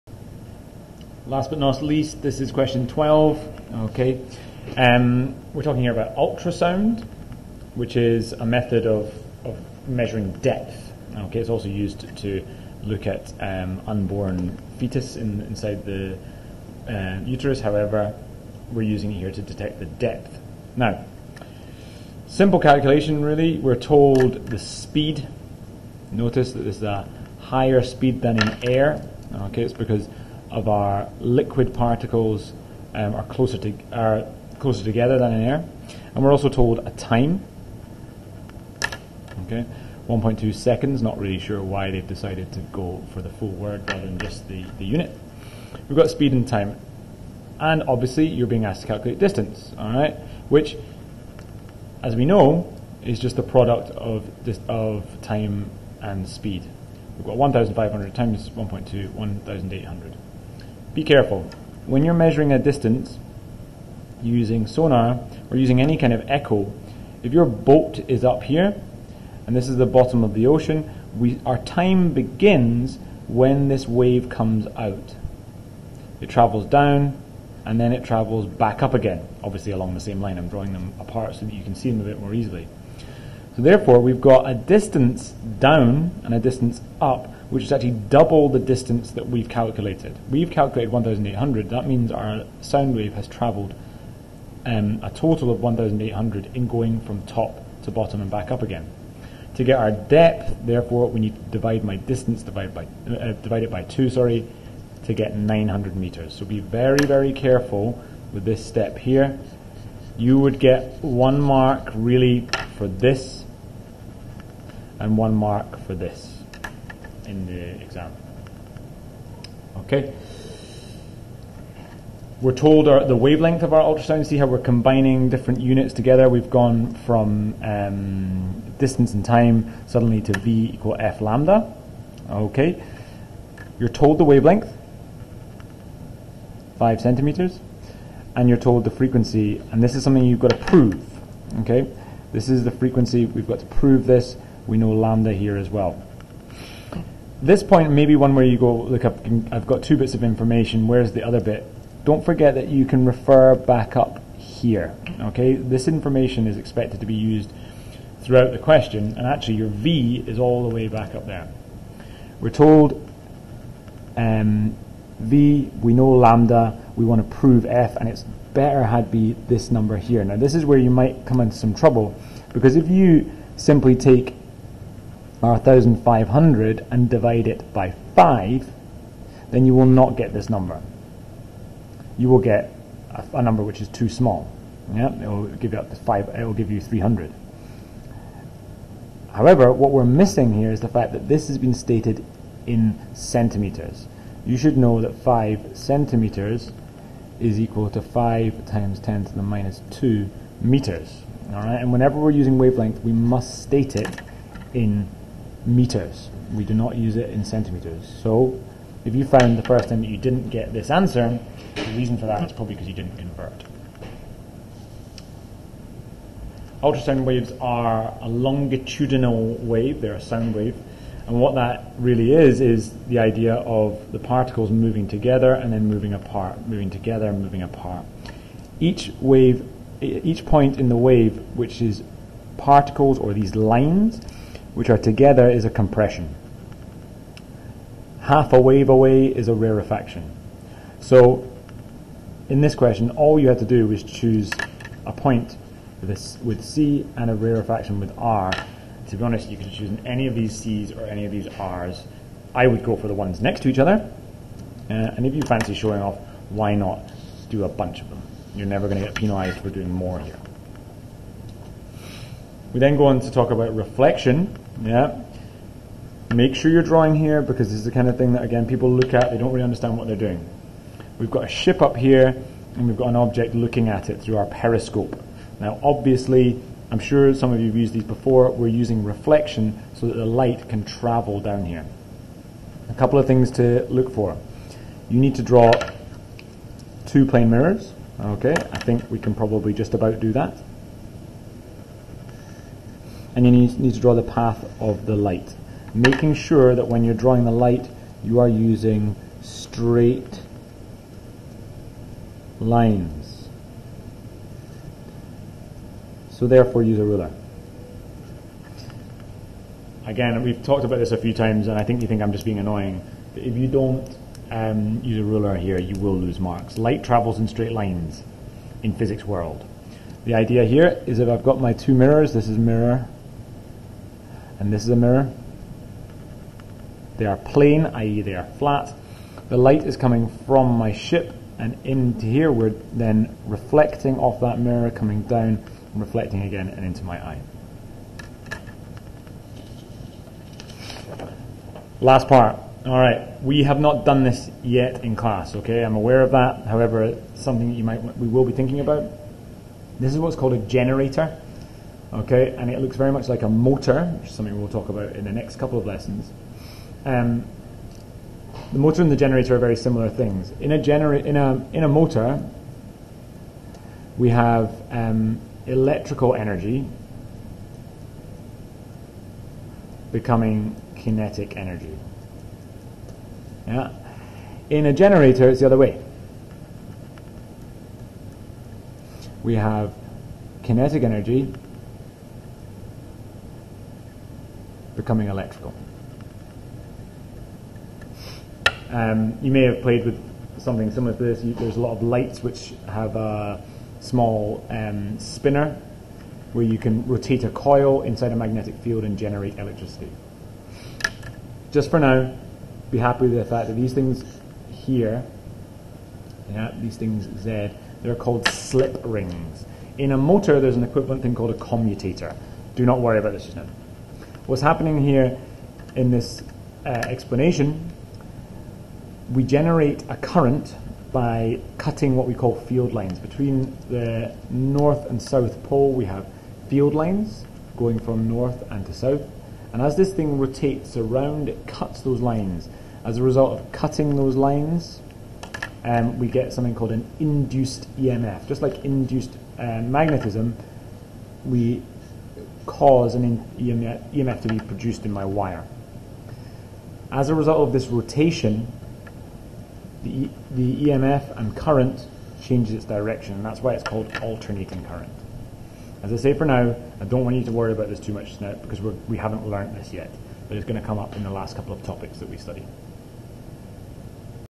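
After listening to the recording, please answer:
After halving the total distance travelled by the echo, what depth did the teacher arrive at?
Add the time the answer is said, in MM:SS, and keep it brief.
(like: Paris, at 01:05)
900 meters, at 01:45.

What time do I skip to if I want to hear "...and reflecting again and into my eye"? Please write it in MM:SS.
05:35.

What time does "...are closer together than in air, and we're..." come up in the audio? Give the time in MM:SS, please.
00:33.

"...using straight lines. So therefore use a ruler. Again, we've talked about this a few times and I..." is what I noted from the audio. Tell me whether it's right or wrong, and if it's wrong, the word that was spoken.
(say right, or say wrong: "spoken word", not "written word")
right.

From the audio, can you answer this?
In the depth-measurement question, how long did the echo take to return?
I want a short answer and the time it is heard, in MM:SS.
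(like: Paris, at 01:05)
1.2 seconds, at 00:40.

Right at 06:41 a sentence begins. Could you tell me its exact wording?
Just for now, be happy with the fact that these things here, yeah, these things Z, they're called slip rings.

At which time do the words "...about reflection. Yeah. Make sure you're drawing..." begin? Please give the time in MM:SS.
04:23.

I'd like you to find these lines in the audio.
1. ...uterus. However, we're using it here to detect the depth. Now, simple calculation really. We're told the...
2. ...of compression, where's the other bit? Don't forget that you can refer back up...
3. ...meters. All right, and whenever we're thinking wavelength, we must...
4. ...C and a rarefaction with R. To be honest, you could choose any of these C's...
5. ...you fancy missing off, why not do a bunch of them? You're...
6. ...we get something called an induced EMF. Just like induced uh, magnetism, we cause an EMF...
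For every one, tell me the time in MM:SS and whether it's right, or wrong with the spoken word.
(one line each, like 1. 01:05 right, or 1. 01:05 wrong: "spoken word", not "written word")
1. 00:17 right
2. 02:30 wrong: "information", not "compression"
3. 03:20 wrong: "using", not "thinking"
4. 04:06 right
5. 04:15 wrong: "showing", not "missing"
6. 07:16 right.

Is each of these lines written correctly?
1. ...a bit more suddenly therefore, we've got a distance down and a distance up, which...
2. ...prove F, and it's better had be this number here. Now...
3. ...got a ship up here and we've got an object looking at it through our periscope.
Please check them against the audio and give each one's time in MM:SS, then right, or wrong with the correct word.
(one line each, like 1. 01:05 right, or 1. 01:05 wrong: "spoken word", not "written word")
1. 01:22 wrong: "easily", not "suddenly"
2. 02:47 right
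3. 04:31 right.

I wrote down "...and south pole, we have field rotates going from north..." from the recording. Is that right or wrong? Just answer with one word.
wrong.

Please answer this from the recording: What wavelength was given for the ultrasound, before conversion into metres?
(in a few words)
5 centimeters.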